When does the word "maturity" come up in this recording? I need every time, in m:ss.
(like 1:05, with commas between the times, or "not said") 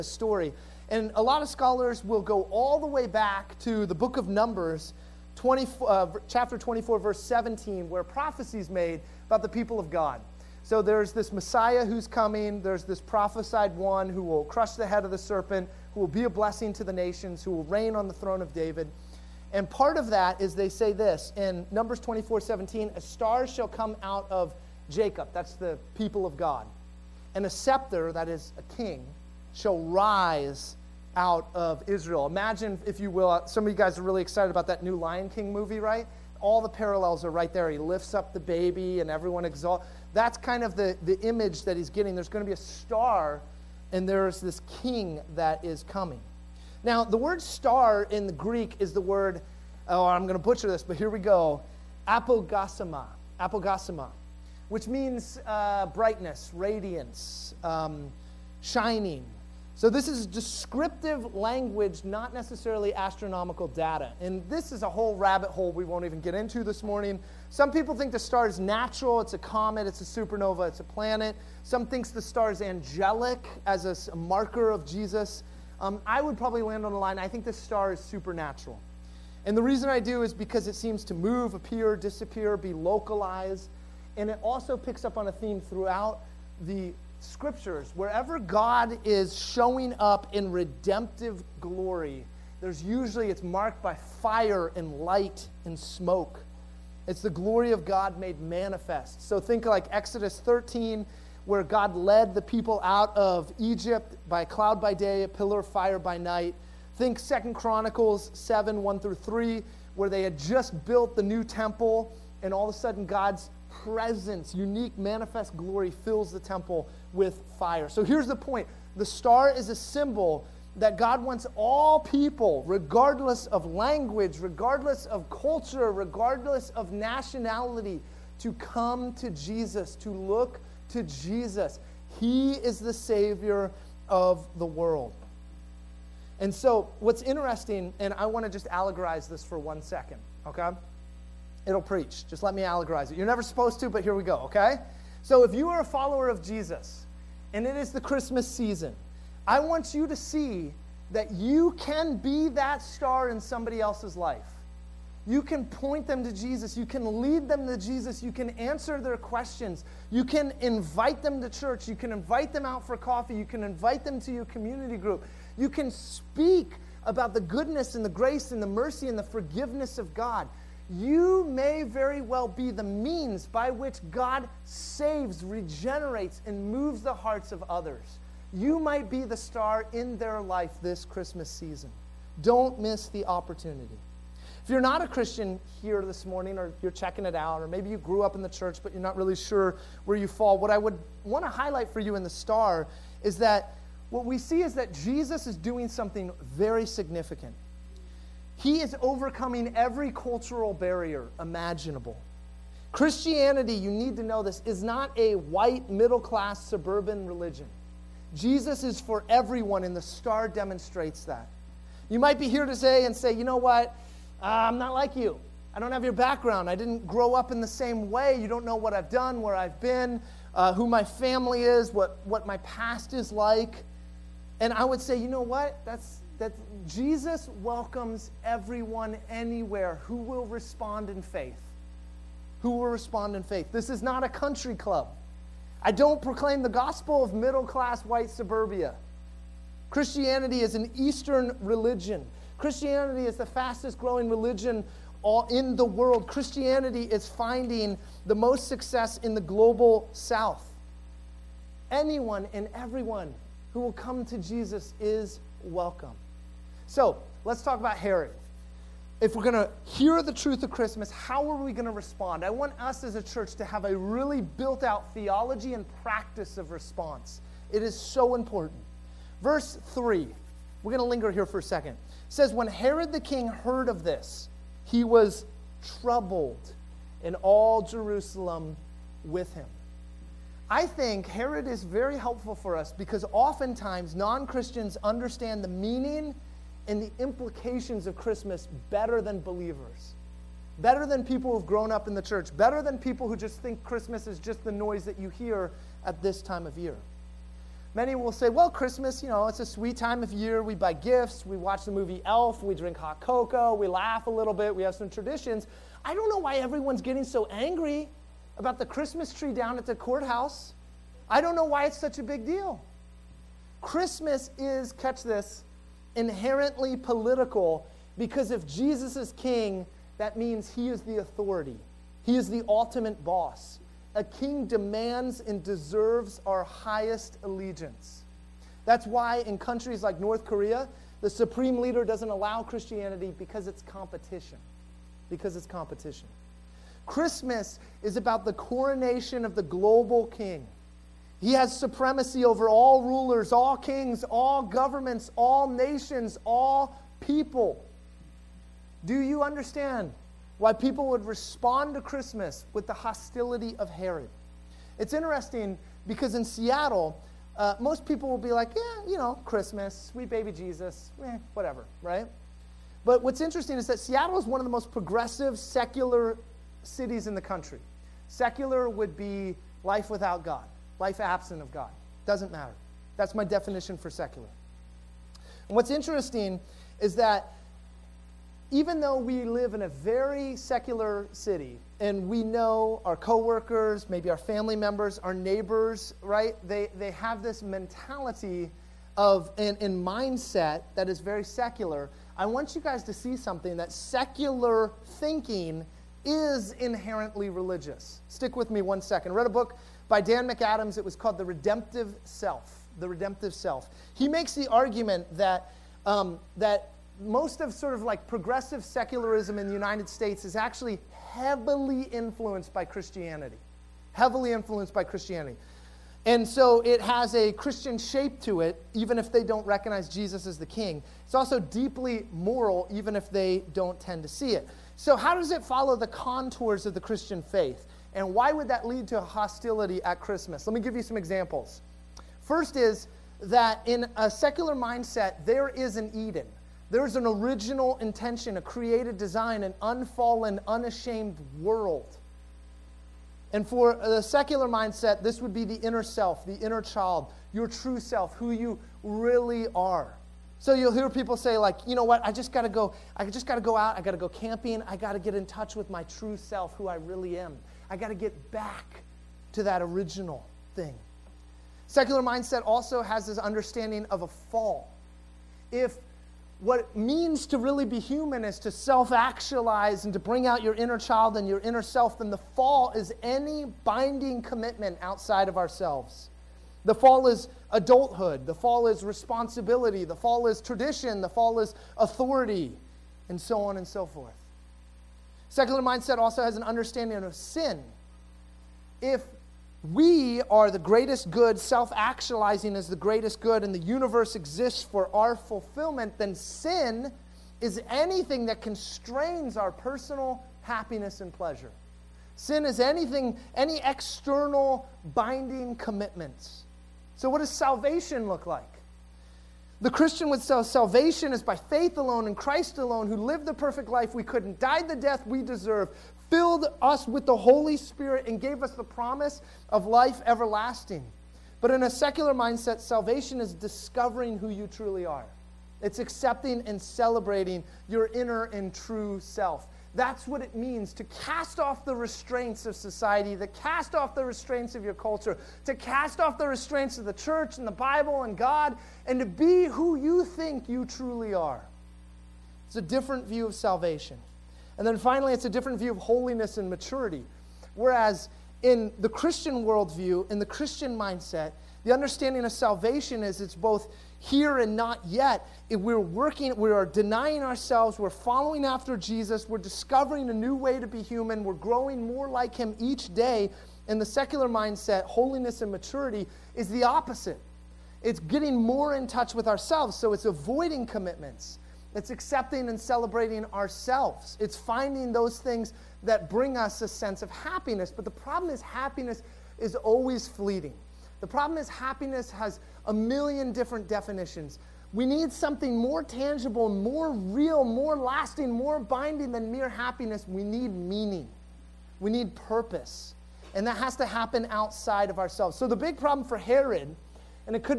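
9:06, 9:25.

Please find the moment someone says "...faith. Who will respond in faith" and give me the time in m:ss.
3:51.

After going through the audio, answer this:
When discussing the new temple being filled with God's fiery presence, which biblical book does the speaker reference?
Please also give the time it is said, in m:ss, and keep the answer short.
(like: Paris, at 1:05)
Second Chronicles, at 1:47.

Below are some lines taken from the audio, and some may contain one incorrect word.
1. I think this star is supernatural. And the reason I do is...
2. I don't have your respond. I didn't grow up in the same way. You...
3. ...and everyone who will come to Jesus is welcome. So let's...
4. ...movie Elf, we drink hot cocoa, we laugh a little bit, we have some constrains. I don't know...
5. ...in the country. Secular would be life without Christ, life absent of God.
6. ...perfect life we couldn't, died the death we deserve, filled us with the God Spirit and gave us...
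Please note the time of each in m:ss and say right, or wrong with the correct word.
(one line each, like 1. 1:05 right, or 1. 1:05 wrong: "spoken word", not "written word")
1. 1:17 right
2. 3:35 wrong: "background", not "respond"
3. 4:12 right
4. 5:01 wrong: "traditions", not "constrains"
5. 6:07 wrong: "God", not "Christ"
6. 8:33 wrong: "Holy", not "God".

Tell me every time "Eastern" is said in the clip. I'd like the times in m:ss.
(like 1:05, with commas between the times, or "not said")
4:00.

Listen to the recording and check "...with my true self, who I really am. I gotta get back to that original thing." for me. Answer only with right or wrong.
right.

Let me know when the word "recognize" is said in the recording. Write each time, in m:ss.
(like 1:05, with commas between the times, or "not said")
6:59.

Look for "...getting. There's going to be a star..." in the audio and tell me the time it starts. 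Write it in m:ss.
0:41.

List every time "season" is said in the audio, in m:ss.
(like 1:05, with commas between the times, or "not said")
2:28, 3:01.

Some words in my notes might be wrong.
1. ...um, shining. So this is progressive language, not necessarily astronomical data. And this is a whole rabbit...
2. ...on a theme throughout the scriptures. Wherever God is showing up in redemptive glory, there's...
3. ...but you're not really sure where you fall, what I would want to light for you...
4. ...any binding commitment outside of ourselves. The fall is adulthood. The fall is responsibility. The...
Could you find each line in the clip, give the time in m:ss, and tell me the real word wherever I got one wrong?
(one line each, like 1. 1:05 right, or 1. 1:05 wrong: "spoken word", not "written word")
1. 0:57 wrong: "descriptive", not "progressive"
2. 1:25 right
3. 3:08 wrong: "highlight", not "light"
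4. 7:53 right.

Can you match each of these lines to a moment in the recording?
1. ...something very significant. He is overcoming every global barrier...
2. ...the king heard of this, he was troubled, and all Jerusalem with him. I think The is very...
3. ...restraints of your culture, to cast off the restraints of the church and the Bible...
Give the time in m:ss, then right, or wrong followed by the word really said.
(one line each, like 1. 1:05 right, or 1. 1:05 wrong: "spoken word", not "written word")
1. 3:15 wrong: "cultural", not "global"
2. 4:33 wrong: "Herod", not "The"
3. 8:54 right.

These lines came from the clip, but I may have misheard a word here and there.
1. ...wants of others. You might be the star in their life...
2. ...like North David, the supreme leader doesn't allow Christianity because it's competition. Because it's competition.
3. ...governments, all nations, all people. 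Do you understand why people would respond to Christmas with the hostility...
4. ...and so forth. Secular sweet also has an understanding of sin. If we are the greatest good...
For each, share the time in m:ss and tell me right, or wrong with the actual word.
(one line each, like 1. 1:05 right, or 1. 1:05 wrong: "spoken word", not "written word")
1. 2:57 wrong: "hearts", not "wants"
2. 5:30 wrong: "Korea", not "David"
3. 5:44 right
4. 8:03 wrong: "mindset", not "sweet".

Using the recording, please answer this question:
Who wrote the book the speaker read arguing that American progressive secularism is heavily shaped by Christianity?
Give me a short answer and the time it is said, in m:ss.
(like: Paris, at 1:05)
Dan McAdams, at 6:40.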